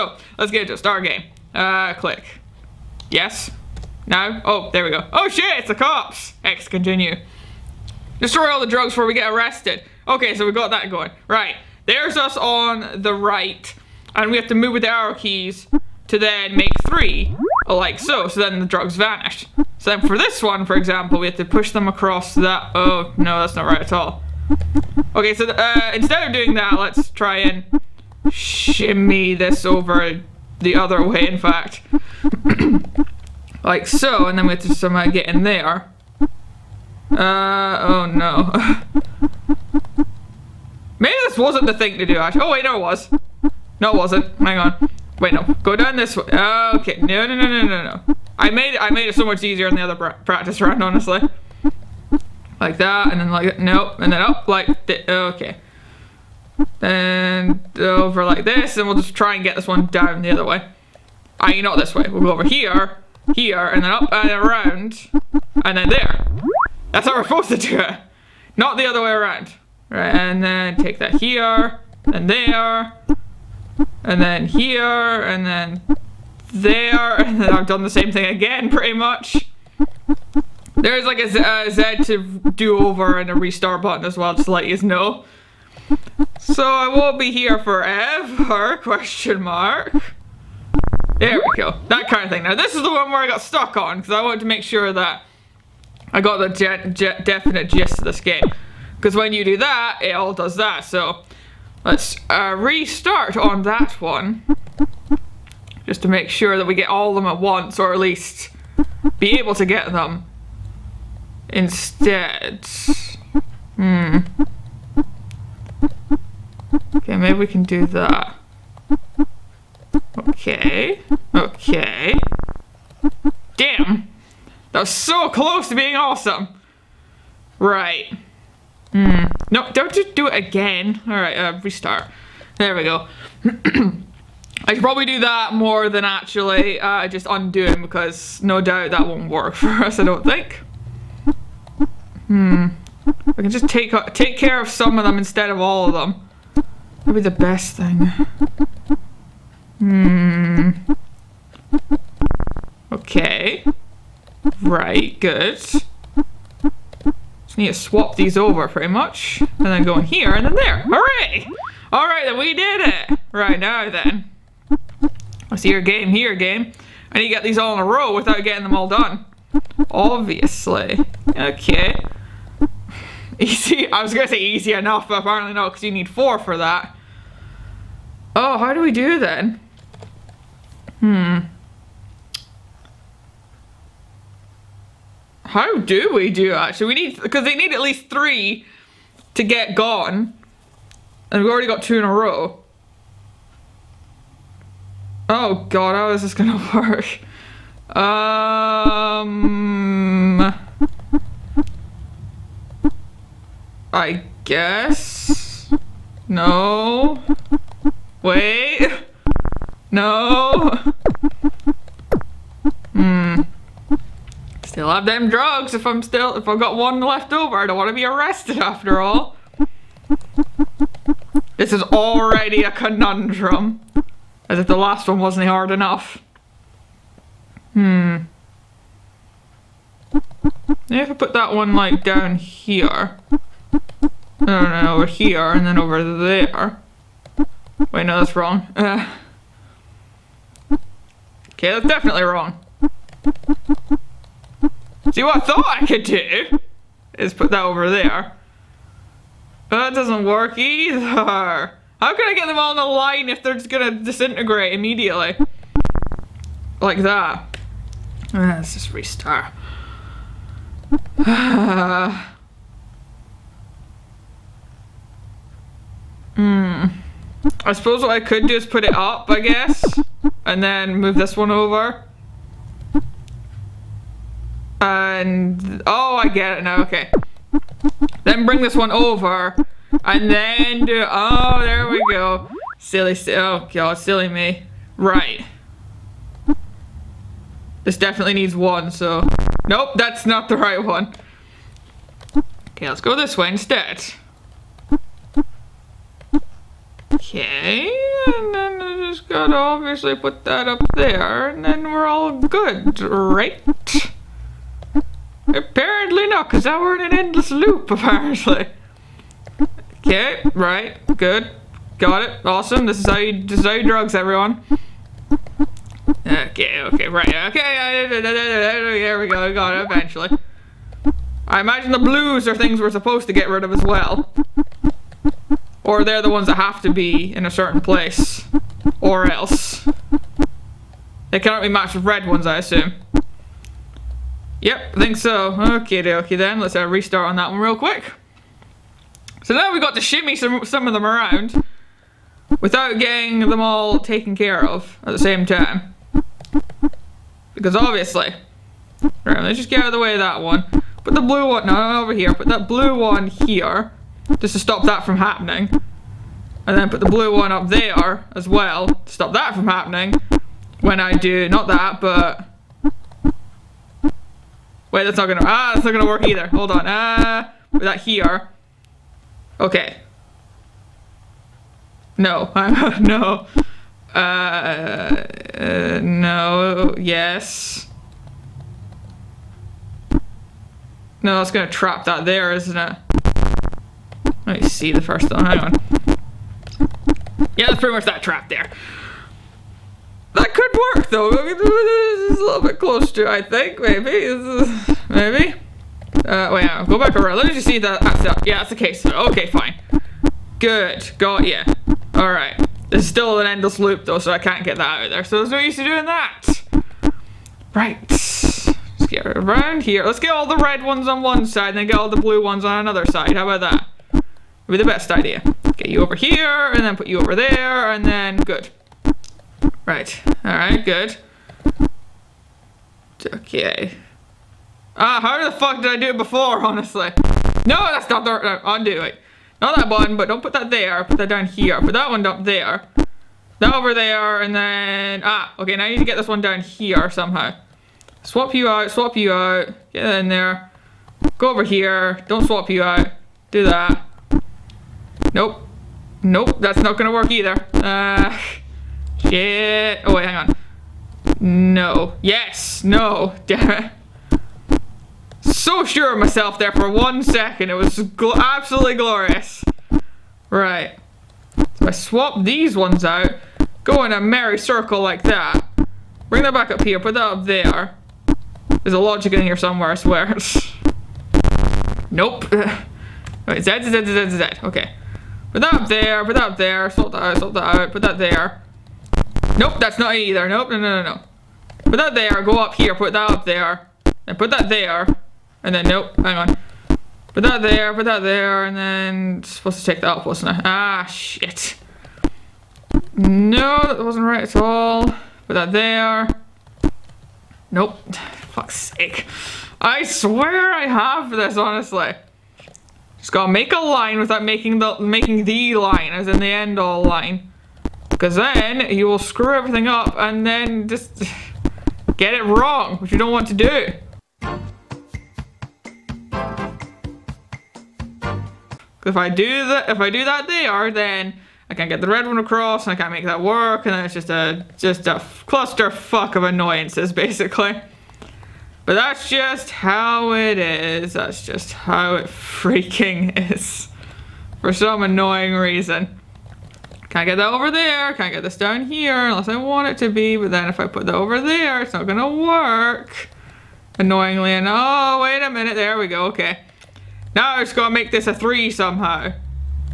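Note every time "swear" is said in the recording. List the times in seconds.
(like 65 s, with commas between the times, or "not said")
469 s, 500 s.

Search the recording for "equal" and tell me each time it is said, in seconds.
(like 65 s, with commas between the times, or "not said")
not said.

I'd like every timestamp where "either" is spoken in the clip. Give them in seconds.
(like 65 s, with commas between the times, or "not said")
250 s, 366 s, 447 s, 480 s.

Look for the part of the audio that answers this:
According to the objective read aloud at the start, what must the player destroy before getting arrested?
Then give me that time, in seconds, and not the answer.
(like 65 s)
8 s.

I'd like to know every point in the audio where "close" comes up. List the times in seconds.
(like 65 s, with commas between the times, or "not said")
125 s, 392 s.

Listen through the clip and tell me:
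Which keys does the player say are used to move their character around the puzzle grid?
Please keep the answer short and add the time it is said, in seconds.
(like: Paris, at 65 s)
Arrow keys, at 14 s.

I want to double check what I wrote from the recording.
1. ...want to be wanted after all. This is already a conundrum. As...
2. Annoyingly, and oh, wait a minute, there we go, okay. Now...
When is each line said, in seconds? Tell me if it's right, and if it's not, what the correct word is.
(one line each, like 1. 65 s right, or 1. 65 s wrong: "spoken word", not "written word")
1. 217 s wrong: "arrested", not "wanted"
2. 543 s right.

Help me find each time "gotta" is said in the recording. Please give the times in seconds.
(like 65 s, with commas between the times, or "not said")
299 s, 503 s, 547 s.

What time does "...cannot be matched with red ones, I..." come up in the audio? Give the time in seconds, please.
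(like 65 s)
331 s.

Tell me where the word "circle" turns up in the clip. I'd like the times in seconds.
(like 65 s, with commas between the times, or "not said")
464 s.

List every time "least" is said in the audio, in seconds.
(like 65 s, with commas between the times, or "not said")
107 s, 187 s.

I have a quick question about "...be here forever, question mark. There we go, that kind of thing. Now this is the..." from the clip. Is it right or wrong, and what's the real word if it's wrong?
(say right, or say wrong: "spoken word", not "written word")
right.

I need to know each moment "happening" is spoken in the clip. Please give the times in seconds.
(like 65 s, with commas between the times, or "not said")
355 s, 359 s.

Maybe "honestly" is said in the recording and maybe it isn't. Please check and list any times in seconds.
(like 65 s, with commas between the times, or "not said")
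50 s, 426 s, 501 s.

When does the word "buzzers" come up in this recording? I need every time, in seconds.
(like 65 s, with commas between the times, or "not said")
not said.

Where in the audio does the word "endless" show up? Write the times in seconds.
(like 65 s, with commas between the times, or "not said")
307 s, 403 s.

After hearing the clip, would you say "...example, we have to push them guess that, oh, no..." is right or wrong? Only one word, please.
wrong.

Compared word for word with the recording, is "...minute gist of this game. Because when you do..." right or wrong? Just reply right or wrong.
wrong.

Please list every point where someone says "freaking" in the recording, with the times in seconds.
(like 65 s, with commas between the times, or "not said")
532 s.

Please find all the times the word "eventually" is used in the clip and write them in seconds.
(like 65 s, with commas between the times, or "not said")
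319 s.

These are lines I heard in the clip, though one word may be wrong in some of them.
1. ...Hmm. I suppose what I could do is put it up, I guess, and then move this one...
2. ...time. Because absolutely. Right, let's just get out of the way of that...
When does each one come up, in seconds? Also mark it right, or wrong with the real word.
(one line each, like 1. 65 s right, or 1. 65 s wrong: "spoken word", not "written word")
1. 266 s right
2. 345 s wrong: "obviously", not "absolutely".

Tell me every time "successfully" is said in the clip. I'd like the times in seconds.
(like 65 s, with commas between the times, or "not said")
not said.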